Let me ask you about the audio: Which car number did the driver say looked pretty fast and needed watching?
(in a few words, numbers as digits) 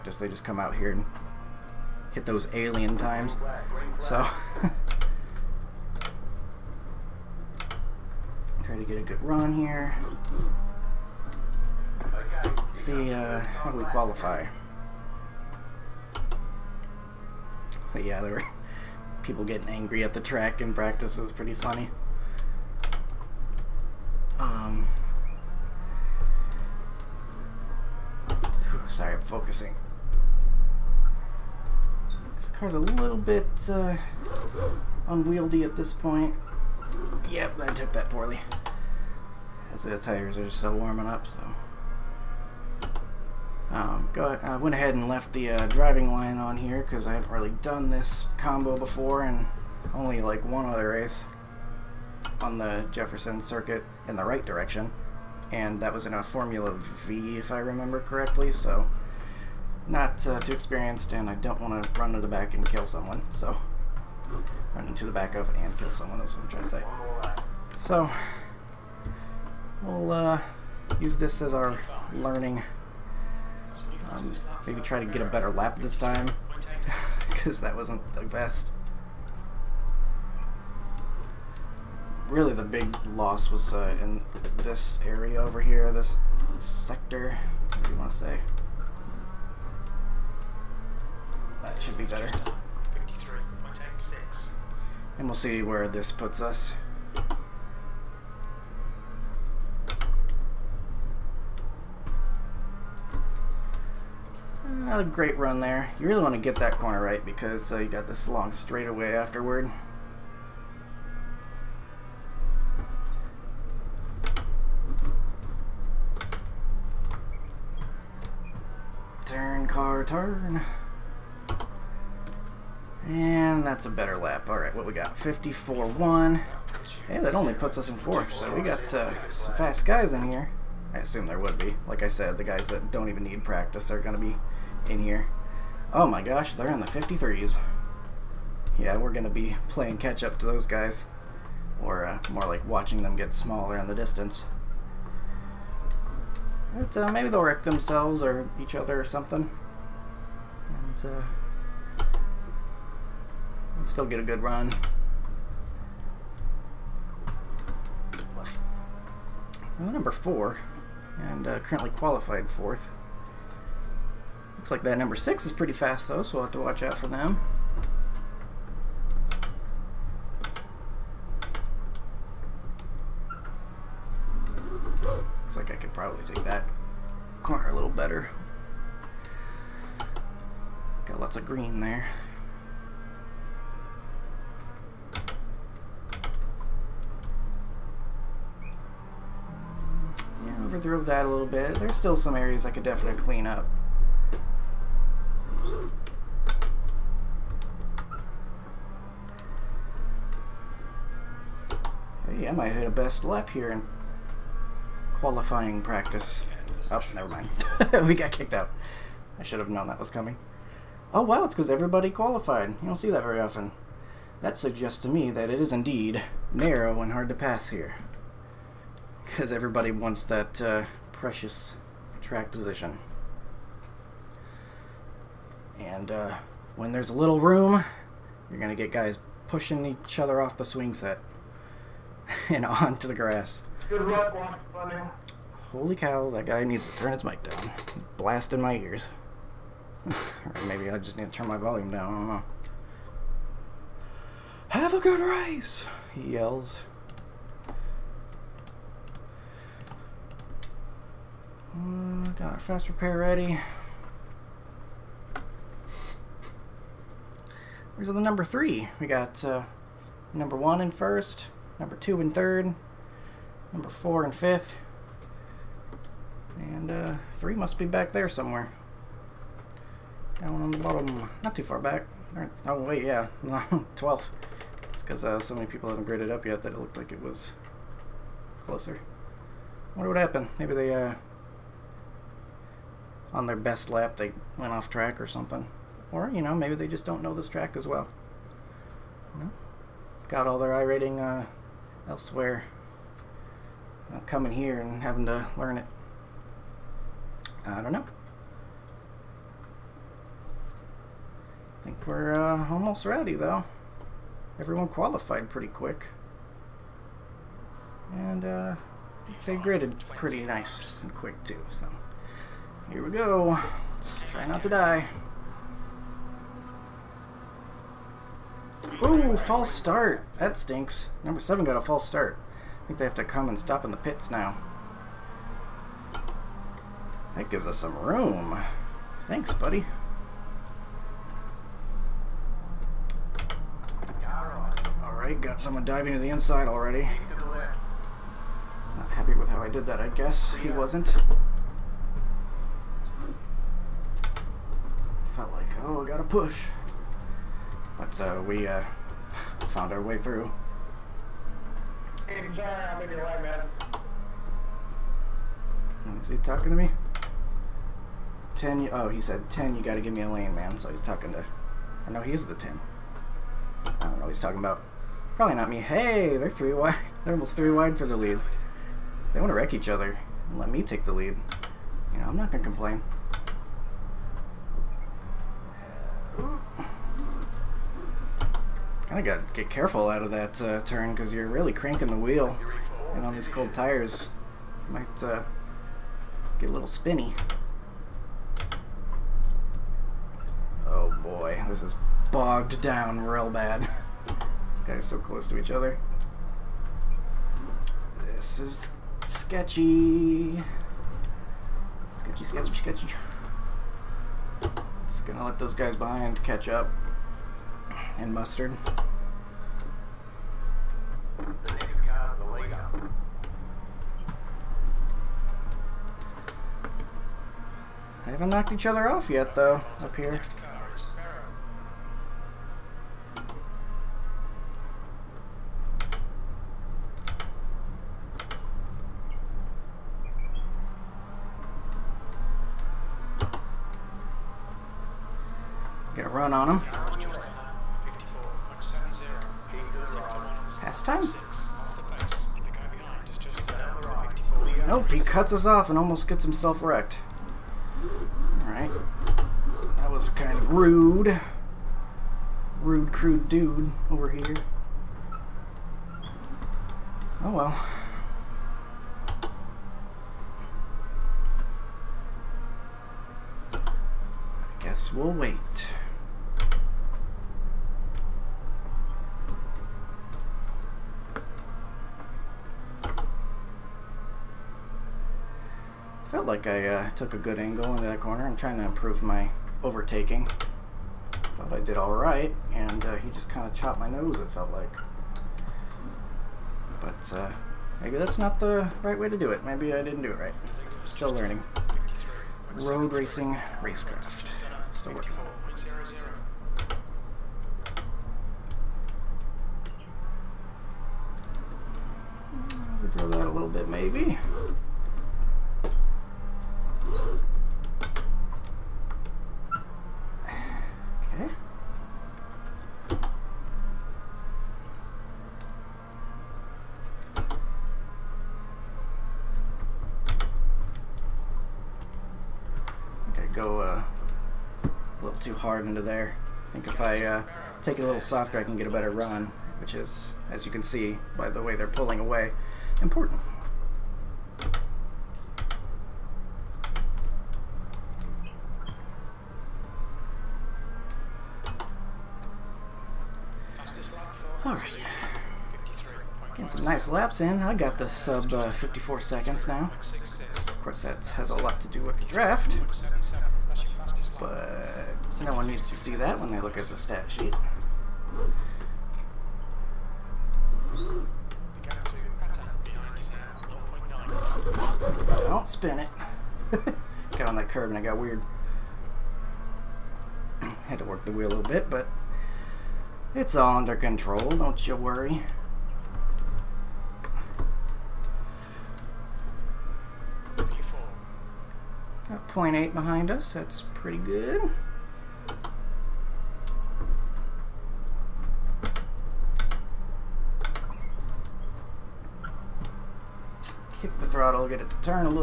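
Number six.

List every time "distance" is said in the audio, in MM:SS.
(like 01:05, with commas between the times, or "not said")
02:23.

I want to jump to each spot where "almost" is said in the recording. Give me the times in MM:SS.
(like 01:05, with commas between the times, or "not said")
05:02, 06:07, 07:25.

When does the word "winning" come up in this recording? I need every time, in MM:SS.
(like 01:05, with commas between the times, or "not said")
not said.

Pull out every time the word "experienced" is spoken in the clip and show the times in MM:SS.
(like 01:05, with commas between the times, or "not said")
01:00.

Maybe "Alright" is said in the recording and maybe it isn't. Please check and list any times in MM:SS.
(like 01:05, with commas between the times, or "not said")
02:04, 05:35, 07:28, 09:04.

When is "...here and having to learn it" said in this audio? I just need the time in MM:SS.
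04:54.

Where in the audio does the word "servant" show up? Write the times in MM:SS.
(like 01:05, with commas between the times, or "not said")
not said.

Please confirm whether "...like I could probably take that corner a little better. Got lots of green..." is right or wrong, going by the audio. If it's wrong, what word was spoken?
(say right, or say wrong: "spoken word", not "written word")
right.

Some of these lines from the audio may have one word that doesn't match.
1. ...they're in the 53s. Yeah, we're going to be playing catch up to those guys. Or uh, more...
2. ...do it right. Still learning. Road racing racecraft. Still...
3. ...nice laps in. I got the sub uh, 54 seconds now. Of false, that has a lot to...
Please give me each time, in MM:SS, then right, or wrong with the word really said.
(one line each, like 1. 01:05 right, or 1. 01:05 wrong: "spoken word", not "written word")
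1. 02:16 right
2. 08:10 right
3. 09:06 wrong: "course", not "false".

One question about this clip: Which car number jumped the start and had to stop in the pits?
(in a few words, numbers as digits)
Number seven.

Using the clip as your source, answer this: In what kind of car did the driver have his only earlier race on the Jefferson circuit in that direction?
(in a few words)
Formula V.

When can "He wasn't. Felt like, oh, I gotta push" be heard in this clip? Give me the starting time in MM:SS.
05:40.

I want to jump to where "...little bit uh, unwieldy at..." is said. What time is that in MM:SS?
00:32.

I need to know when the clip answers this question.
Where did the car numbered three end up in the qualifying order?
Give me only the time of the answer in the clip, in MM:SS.
04:33.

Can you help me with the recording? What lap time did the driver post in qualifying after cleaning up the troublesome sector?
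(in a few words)
54.1.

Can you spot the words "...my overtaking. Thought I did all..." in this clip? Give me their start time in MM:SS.
07:59.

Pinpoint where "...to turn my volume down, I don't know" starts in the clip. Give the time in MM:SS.
04:01.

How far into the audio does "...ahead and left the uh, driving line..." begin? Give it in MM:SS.
00:44.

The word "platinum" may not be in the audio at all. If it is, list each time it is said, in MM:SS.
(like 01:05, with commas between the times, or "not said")
not said.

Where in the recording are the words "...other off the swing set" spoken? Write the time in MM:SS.
03:50.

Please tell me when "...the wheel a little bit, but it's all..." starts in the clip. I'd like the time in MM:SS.
09:31.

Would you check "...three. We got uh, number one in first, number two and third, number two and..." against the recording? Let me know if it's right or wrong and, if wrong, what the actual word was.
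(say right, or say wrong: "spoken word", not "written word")
wrong: "four", not "two".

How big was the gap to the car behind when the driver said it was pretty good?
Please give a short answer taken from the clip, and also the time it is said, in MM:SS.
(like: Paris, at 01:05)
0.8, at 09:42.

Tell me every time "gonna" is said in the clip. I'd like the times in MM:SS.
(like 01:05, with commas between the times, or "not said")
06:12, 06:45.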